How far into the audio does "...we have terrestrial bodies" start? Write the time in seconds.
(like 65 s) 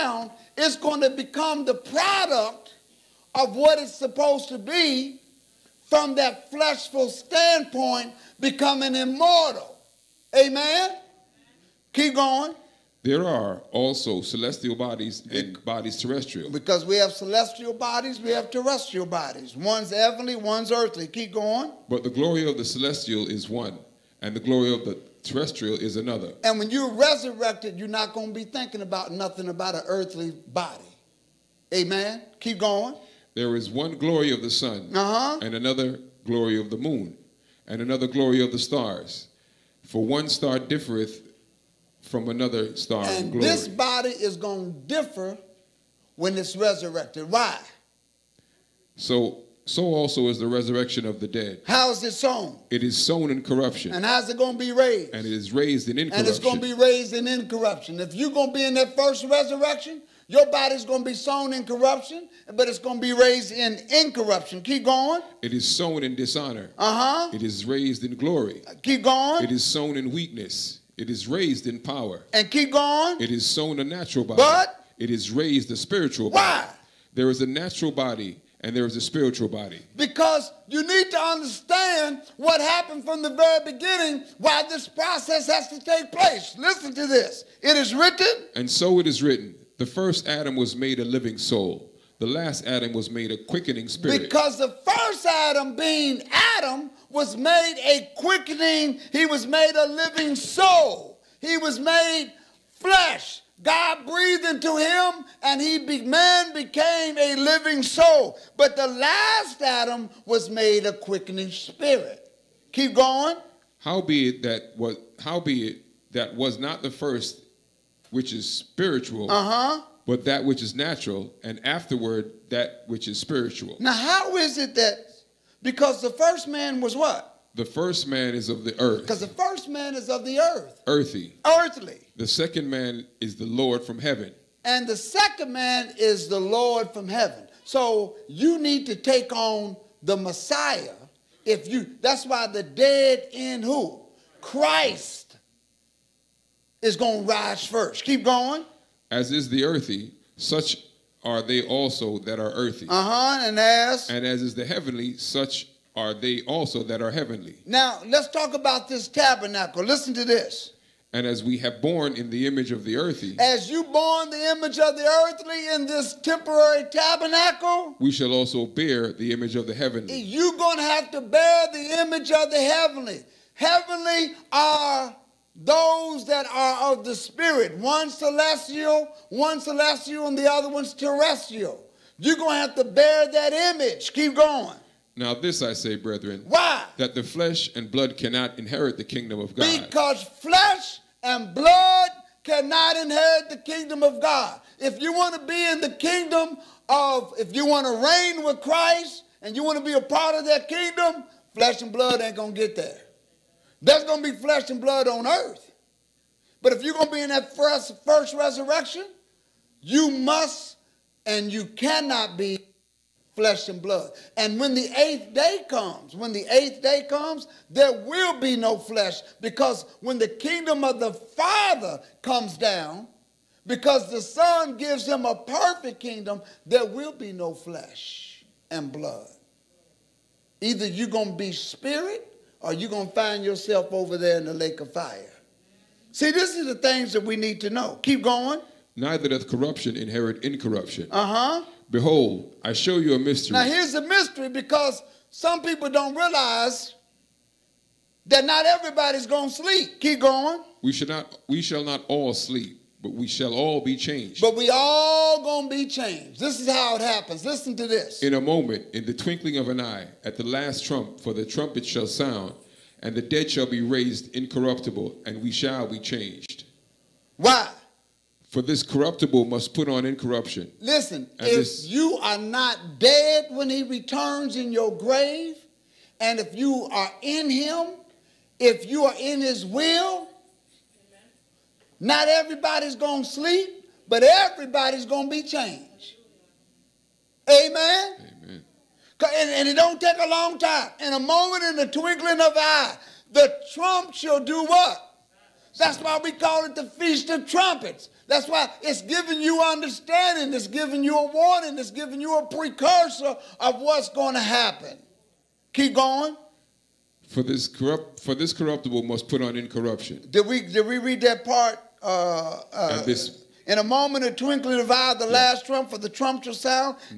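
18 s.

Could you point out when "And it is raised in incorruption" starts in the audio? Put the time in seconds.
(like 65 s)
55 s.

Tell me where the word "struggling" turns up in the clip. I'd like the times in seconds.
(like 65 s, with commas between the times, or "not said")
not said.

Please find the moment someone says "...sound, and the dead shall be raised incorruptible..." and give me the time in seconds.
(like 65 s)
262 s.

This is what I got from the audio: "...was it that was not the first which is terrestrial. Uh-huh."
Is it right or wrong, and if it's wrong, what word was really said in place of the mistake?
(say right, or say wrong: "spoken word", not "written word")
wrong: "spiritual", not "terrestrial".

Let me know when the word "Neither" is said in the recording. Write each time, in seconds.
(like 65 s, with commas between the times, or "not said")
238 s.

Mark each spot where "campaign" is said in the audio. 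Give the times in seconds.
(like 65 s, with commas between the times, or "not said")
not said.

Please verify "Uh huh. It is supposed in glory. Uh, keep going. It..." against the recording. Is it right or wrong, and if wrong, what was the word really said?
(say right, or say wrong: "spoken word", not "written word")
wrong: "raised", not "supposed".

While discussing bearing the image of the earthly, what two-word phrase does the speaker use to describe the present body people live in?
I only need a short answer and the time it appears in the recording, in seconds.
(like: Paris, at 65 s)
temporary tabernacle, at 166 s.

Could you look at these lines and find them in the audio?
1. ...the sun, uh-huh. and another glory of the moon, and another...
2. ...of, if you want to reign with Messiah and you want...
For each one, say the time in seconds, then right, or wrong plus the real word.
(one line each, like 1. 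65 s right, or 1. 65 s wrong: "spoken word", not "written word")
1. 34 s right
2. 196 s wrong: "Christ", not "Messiah".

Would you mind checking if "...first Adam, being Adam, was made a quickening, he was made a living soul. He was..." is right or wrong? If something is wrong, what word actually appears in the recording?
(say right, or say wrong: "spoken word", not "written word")
right.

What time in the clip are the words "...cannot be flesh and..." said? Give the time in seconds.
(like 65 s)
211 s.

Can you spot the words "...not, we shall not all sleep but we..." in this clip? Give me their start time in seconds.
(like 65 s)
251 s.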